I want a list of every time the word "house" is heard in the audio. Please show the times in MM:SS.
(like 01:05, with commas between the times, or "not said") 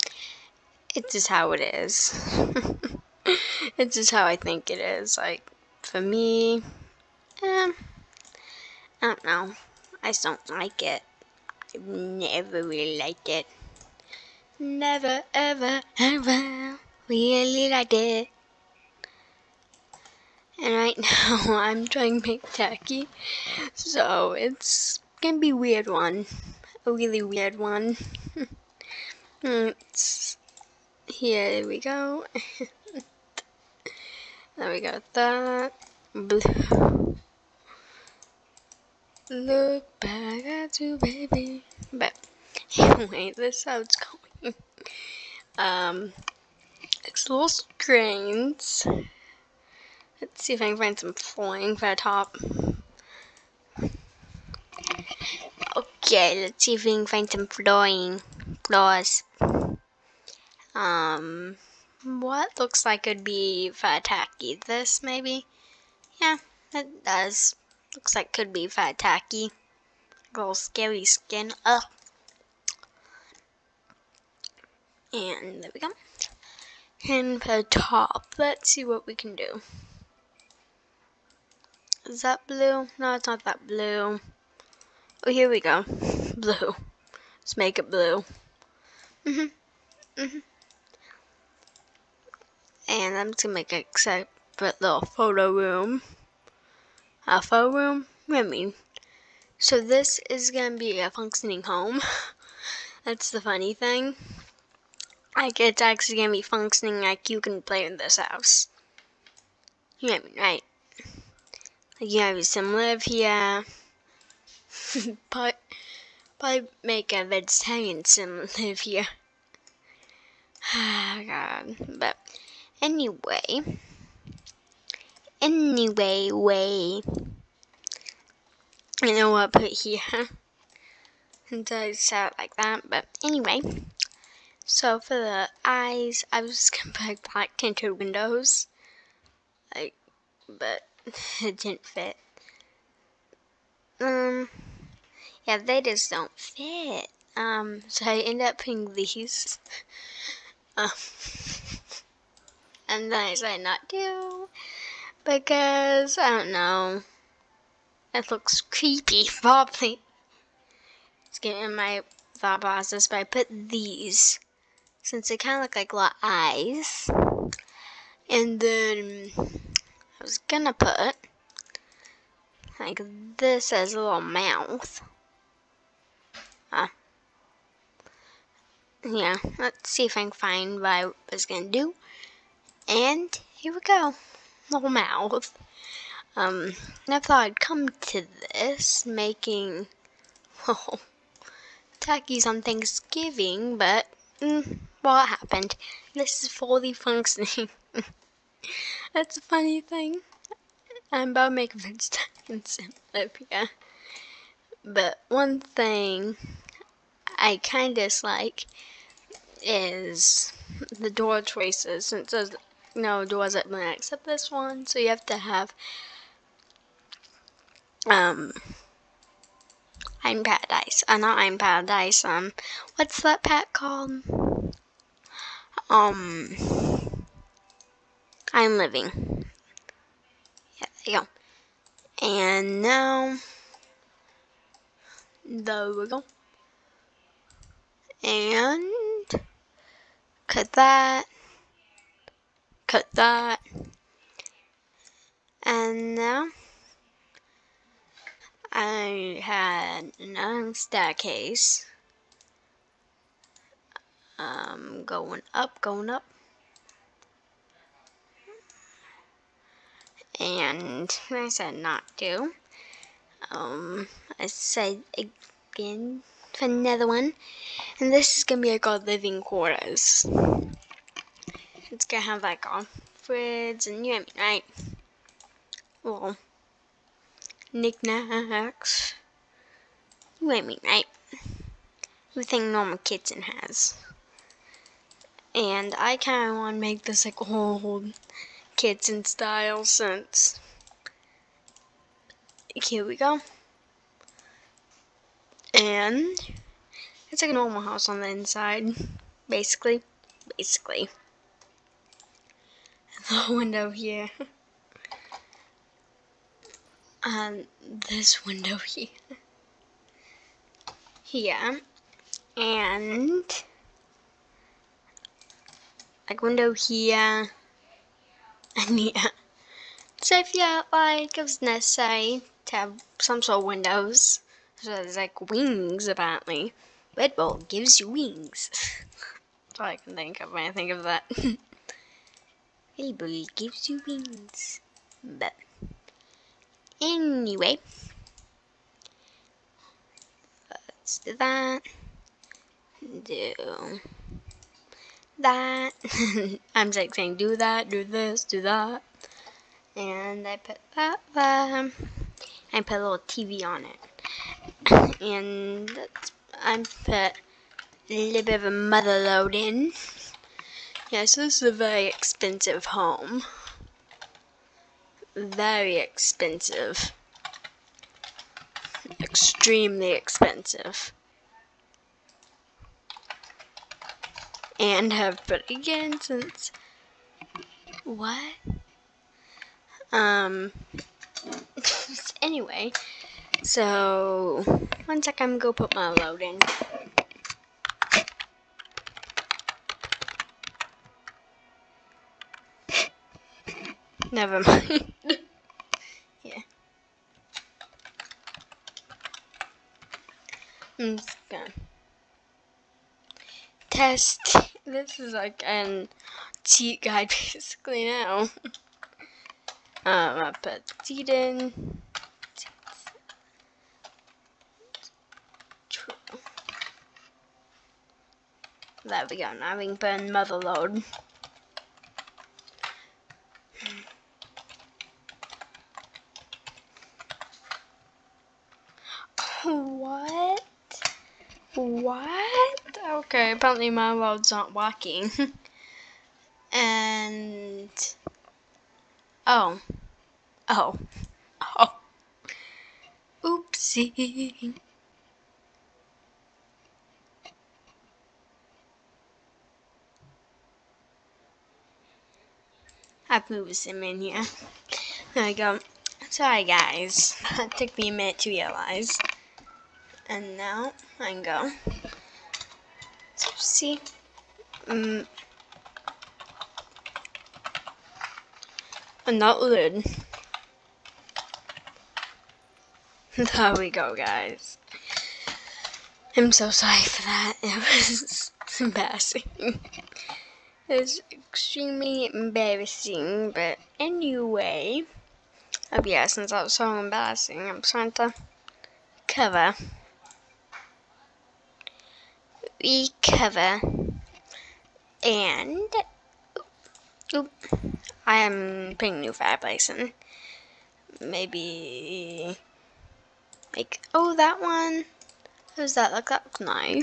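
01:48, 04:57.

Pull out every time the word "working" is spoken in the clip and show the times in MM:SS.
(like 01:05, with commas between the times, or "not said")
07:14.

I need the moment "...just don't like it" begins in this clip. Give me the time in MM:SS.
00:10.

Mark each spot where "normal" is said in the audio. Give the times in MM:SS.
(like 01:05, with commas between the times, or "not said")
04:42, 04:57.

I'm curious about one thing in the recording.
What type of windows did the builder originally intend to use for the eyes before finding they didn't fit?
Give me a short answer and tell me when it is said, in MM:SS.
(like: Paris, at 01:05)
Black tinted windows, at 02:17.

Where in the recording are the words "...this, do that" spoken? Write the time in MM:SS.
05:48.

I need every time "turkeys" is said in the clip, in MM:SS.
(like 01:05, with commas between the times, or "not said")
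03:11.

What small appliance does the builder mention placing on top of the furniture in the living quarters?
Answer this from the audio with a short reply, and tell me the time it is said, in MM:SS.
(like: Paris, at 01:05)
TV, at 05:53.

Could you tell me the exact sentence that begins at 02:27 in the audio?
Um, so I end up putting these.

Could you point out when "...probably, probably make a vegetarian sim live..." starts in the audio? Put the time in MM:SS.
01:55.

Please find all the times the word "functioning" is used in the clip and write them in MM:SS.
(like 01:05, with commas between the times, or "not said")
01:41, 01:46, 03:16.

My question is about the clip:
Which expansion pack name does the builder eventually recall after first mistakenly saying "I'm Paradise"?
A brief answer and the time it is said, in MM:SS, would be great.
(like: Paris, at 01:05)
I'm Living, at 03:48.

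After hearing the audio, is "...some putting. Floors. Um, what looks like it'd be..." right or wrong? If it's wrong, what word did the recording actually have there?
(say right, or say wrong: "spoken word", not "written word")
wrong: "flooring", not "putting".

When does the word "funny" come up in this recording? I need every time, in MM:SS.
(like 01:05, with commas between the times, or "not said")
01:43, 03:19.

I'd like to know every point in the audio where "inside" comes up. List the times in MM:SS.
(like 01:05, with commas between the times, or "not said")
04:58.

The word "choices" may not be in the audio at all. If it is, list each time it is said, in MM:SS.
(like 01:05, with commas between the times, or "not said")
03:31.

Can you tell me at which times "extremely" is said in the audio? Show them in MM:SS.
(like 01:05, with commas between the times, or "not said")
06:09, 08:01.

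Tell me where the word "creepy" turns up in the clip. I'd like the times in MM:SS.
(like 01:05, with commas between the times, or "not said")
02:38.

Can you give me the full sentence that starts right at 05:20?
So if yeah, like it was necessary to have some sort of windows.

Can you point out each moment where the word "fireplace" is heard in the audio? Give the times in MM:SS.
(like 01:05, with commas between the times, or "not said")
08:19.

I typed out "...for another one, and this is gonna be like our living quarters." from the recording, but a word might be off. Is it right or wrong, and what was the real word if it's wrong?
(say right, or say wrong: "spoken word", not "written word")
right.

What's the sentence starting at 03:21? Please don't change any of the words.
I'm about to make a mistake in yeah.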